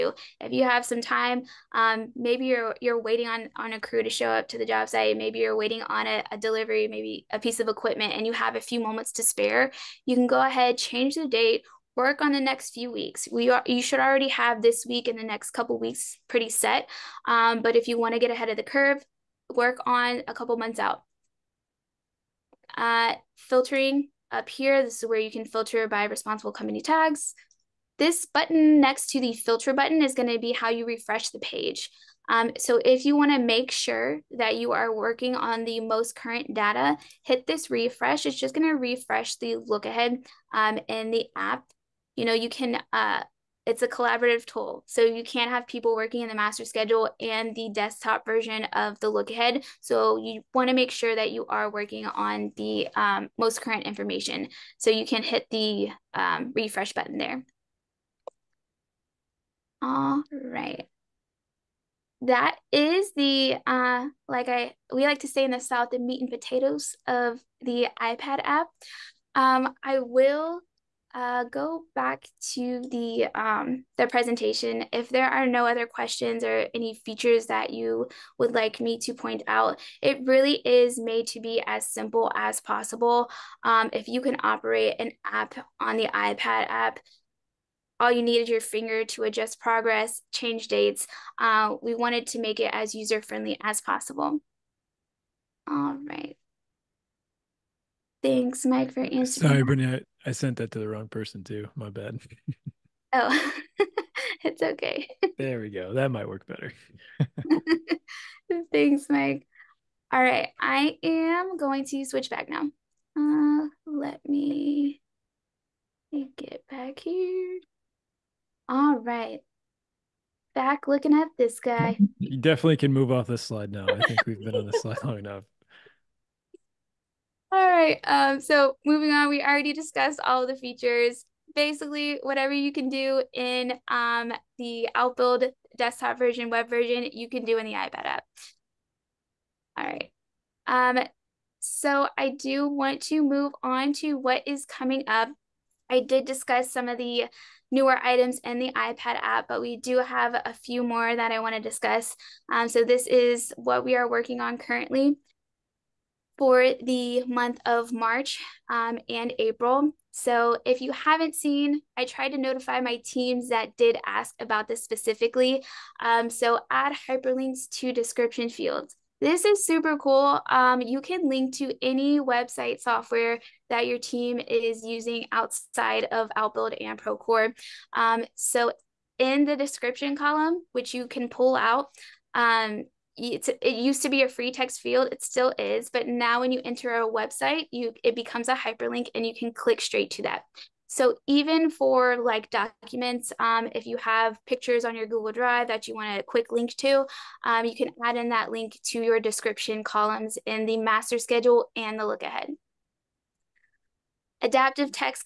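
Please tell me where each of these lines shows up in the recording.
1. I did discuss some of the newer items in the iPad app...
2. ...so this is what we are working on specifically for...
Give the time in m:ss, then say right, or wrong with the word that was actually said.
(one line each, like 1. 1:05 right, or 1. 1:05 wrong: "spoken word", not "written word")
1. 2:25 right
2. 2:32 wrong: "currently", not "specifically".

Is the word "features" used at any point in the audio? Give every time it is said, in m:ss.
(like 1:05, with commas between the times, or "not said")
1:16, 2:10.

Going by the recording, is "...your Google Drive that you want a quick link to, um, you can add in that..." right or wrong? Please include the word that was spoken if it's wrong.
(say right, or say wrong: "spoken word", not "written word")
right.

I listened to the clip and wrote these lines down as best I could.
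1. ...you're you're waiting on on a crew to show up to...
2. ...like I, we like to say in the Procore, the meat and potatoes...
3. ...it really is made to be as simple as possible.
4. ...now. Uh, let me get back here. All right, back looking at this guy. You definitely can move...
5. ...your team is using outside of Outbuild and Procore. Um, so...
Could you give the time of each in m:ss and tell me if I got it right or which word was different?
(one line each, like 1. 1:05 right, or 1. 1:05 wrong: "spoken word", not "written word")
1. 0:02 right
2. 1:04 wrong: "South", not "Procore"
3. 1:20 right
4. 1:52 right
5. 2:53 right.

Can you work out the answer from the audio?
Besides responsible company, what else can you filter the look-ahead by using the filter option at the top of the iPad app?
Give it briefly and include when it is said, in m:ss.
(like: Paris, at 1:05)
Tags, at 0:26.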